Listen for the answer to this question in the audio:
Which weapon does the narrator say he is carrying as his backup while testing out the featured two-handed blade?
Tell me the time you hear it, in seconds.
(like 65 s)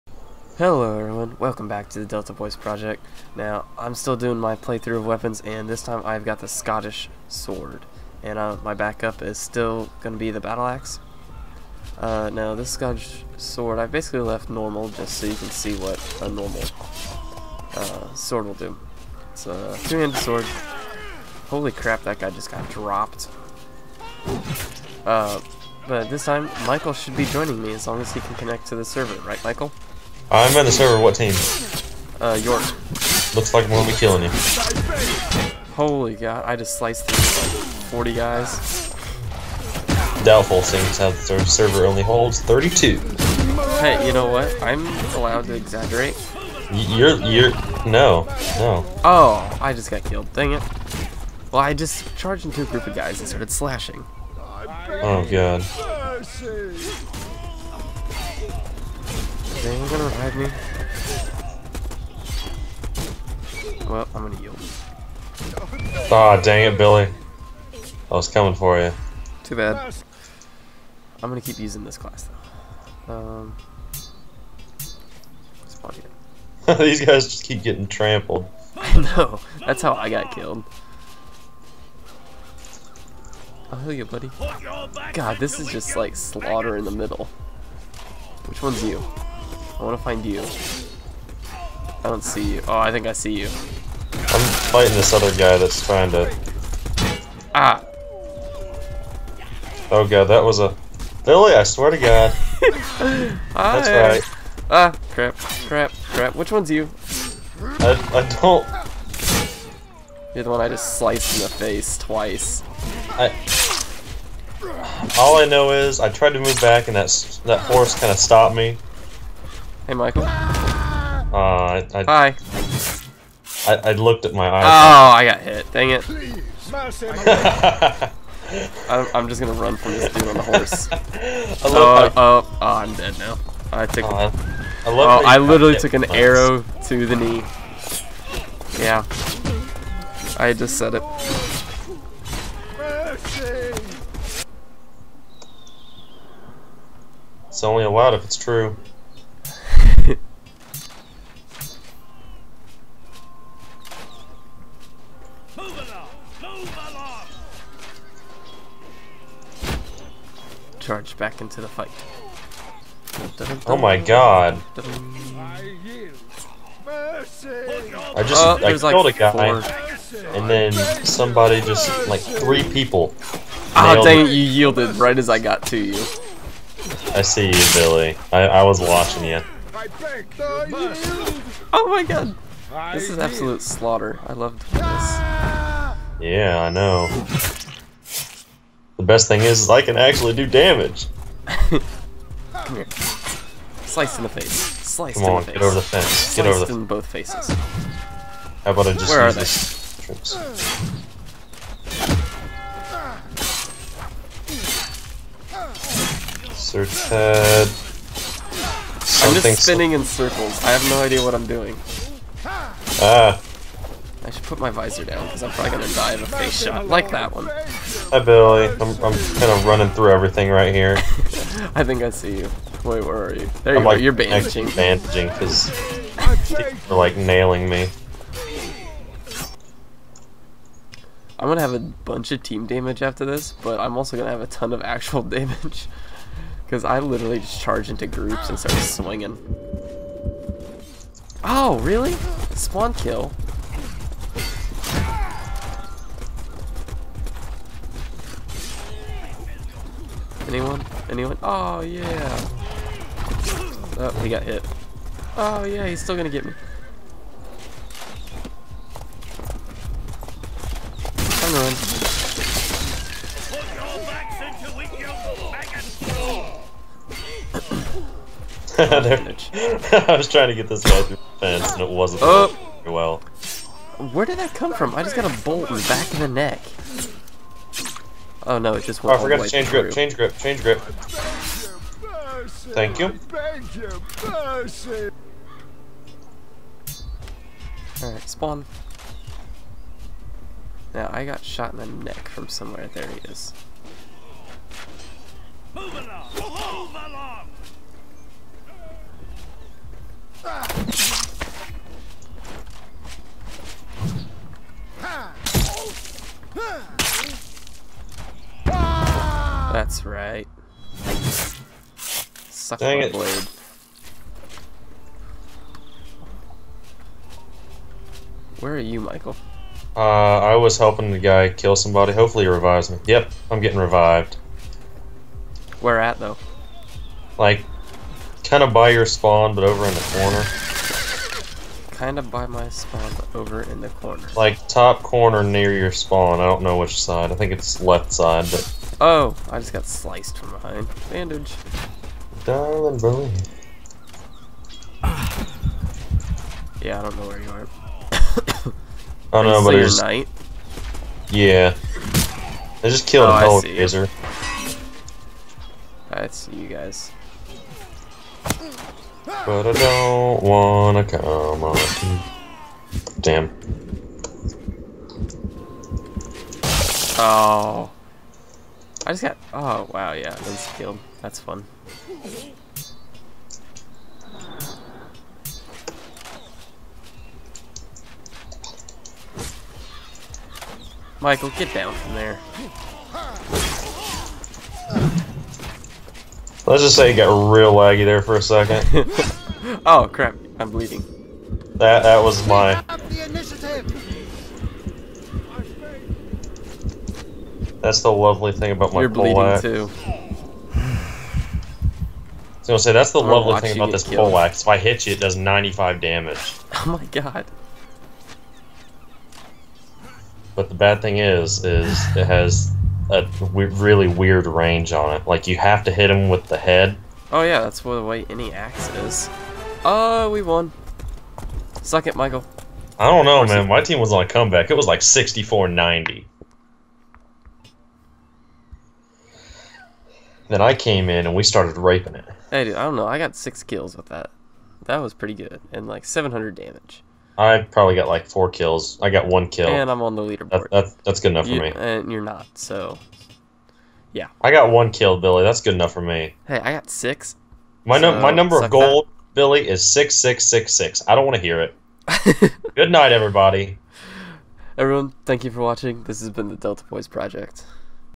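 10 s.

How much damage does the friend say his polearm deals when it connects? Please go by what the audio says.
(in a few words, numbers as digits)
95.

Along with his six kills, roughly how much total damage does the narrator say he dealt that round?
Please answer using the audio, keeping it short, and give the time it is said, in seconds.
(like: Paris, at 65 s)
700, at 436 s.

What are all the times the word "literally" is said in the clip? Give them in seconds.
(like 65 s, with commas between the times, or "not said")
135 s, 236 s.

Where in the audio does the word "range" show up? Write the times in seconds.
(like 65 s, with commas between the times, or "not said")
414 s.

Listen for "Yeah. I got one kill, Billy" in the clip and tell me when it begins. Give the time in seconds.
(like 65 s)
444 s.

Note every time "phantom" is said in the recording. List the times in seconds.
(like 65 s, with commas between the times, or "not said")
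not said.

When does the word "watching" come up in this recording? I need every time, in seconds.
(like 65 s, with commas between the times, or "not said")
178 s, 455 s.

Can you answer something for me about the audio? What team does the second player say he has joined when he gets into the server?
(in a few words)
York.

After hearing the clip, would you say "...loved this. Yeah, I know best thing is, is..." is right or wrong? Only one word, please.
right.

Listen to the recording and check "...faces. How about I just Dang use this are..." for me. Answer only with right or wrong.
wrong.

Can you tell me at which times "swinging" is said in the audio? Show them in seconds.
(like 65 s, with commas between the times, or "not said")
238 s.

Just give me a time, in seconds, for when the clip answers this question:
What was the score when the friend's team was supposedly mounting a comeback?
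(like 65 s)
424 s.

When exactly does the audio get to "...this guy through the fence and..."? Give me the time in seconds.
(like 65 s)
270 s.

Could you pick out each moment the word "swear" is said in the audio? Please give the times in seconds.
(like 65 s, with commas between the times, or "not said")
101 s.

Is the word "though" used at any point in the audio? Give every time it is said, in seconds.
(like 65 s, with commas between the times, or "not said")
73 s, 326 s.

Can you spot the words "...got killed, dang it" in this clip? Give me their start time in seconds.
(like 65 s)
49 s.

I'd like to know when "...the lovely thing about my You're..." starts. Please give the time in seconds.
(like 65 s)
398 s.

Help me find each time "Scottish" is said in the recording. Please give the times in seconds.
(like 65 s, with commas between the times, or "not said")
6 s, 12 s.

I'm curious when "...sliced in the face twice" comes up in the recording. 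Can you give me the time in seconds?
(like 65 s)
110 s.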